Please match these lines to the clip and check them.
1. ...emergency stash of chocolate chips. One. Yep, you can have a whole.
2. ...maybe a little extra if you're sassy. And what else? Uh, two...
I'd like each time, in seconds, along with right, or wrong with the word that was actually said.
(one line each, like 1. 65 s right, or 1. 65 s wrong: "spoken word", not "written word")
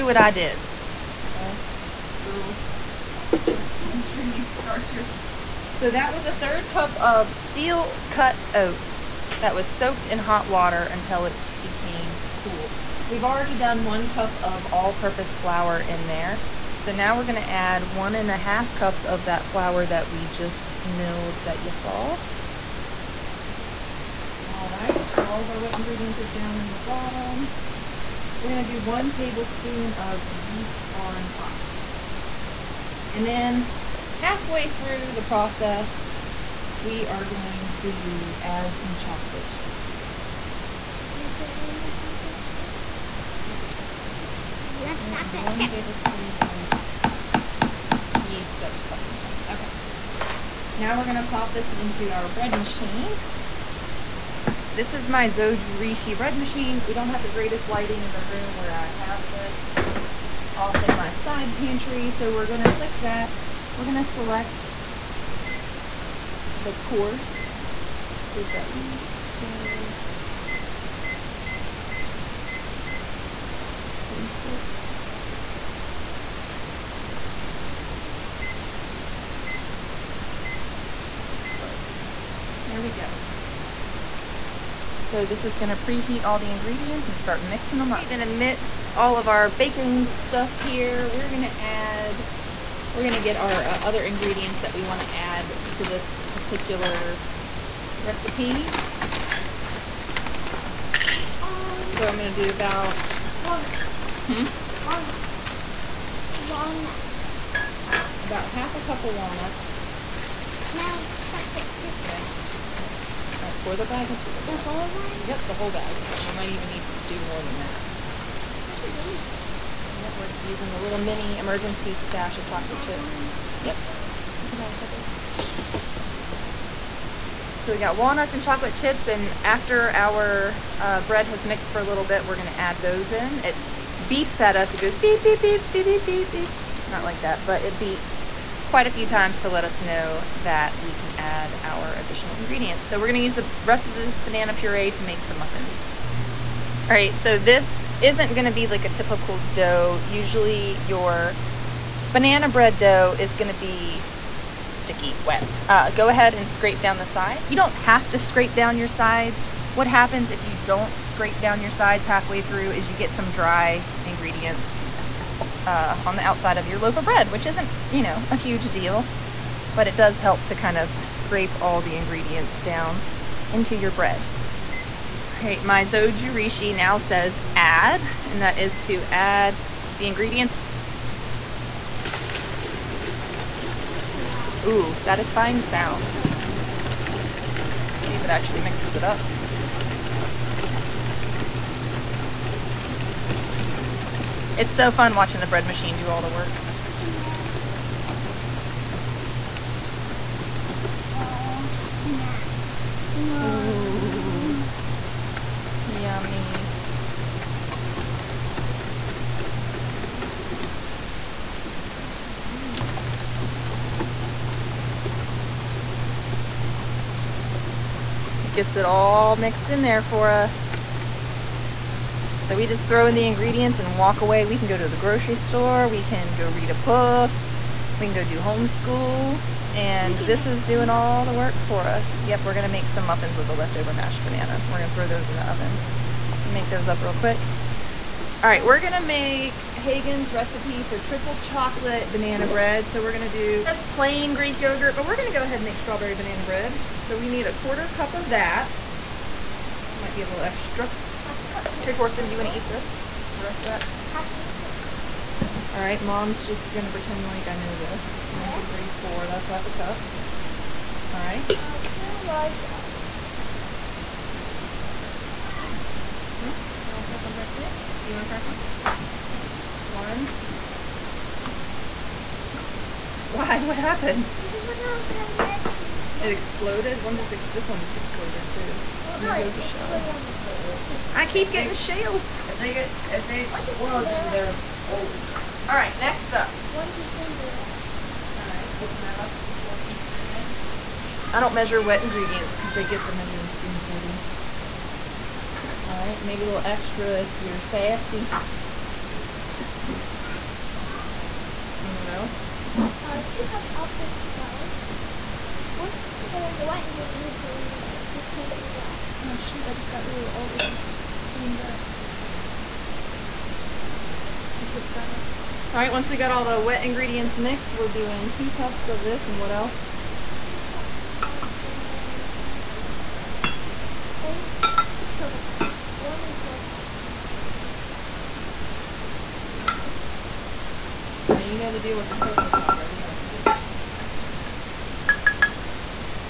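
1. 121 s wrong: "couple", not "whole"
2. 296 s right.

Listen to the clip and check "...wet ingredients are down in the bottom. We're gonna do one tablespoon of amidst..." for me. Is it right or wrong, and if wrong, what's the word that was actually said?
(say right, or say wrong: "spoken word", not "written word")
wrong: "yeast", not "amidst".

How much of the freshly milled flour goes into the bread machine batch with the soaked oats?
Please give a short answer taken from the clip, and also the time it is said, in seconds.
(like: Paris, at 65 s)
1.5 cups, at 17 s.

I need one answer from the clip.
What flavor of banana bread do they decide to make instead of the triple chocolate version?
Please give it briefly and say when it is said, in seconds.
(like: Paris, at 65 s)
Strawberry banana bread, at 245 s.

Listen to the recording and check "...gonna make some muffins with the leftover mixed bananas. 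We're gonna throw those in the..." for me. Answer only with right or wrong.
wrong.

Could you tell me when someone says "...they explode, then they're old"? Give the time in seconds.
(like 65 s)
283 s.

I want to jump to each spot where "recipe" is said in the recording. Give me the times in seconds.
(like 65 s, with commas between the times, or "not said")
98 s, 240 s.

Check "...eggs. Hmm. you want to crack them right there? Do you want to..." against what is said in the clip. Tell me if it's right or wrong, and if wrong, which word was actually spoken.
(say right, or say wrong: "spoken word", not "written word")
right.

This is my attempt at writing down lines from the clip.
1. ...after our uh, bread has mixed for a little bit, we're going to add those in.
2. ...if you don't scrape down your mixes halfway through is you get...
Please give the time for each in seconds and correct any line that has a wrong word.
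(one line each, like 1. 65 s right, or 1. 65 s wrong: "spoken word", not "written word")
1. 129 s right
2. 160 s wrong: "sides", not "mixes".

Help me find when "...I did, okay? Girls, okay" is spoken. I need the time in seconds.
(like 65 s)
0 s.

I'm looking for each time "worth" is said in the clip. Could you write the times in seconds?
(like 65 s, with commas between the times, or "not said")
not said.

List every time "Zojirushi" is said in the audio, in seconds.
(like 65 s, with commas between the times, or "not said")
55 s, 175 s.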